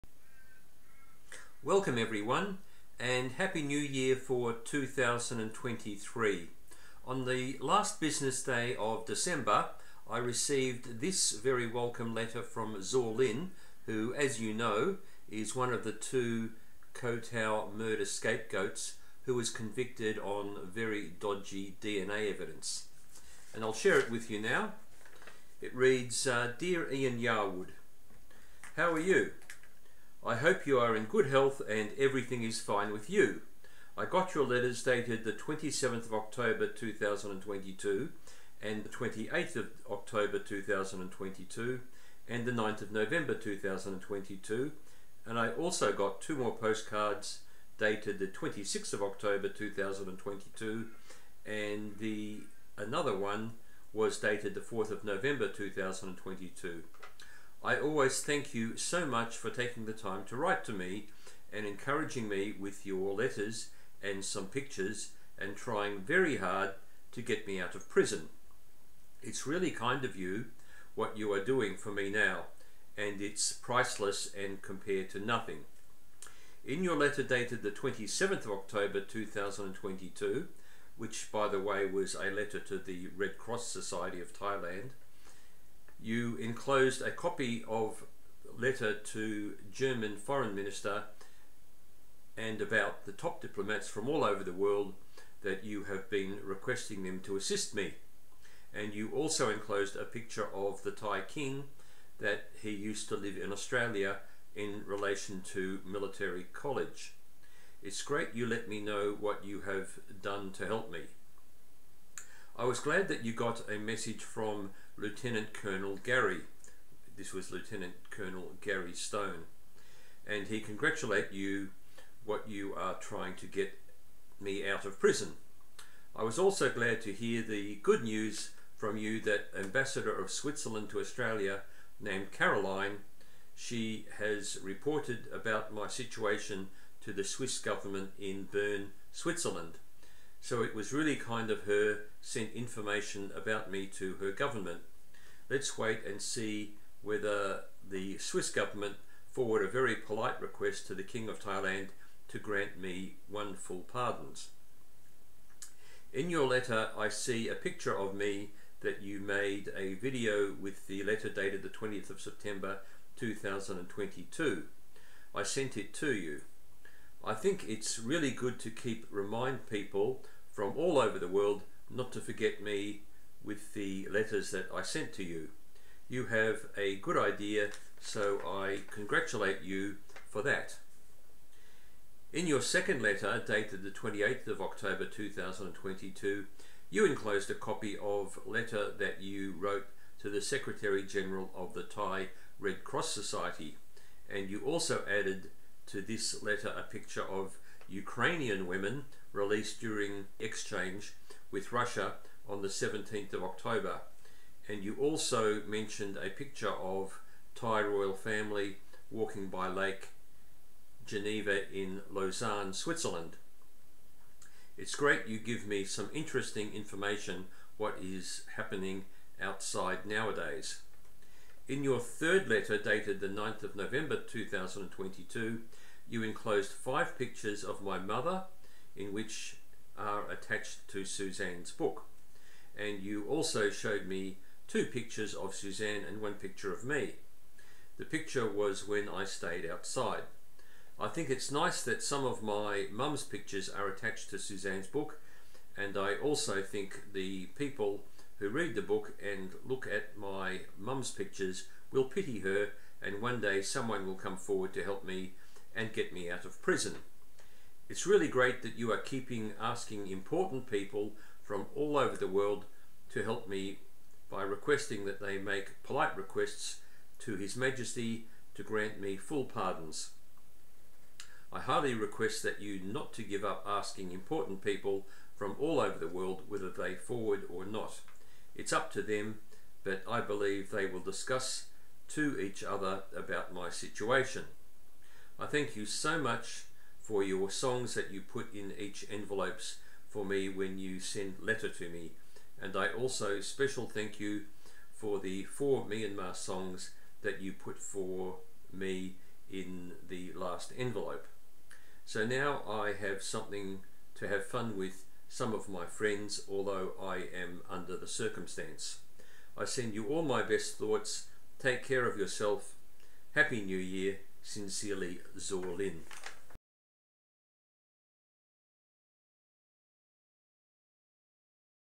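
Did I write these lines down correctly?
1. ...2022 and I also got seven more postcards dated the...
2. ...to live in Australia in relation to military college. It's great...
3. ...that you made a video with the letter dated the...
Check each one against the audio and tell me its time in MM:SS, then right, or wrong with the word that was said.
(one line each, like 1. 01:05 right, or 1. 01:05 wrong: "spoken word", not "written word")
1. 00:43 wrong: "two", not "seven"
2. 01:43 right
3. 02:38 right.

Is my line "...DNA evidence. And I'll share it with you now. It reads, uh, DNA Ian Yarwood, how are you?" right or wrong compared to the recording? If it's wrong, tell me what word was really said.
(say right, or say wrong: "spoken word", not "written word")
wrong: "Dear", not "DNA".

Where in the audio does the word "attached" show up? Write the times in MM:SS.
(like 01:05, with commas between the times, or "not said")
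03:50, 04:03.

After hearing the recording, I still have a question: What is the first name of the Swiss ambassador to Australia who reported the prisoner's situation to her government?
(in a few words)
Caroline.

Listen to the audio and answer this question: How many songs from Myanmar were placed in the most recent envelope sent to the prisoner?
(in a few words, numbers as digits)
4.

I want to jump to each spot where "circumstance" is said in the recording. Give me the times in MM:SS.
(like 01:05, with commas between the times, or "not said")
05:08.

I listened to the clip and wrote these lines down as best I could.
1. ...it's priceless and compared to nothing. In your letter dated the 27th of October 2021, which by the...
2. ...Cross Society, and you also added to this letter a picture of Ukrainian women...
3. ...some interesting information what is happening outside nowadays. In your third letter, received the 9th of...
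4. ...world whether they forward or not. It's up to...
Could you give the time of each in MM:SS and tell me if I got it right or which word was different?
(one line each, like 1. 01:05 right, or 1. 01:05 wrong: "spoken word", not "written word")
1. 01:13 wrong: "2022", not "2021"
2. 03:12 right
3. 03:35 wrong: "dated", not "received"
4. 04:36 right.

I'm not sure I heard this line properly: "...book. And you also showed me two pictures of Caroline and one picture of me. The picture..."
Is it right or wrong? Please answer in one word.
wrong.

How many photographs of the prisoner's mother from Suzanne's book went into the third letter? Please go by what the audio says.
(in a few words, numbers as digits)
5.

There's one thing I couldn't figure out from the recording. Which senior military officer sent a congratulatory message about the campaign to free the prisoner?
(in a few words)
Lieutenant Colonel Gary Stone.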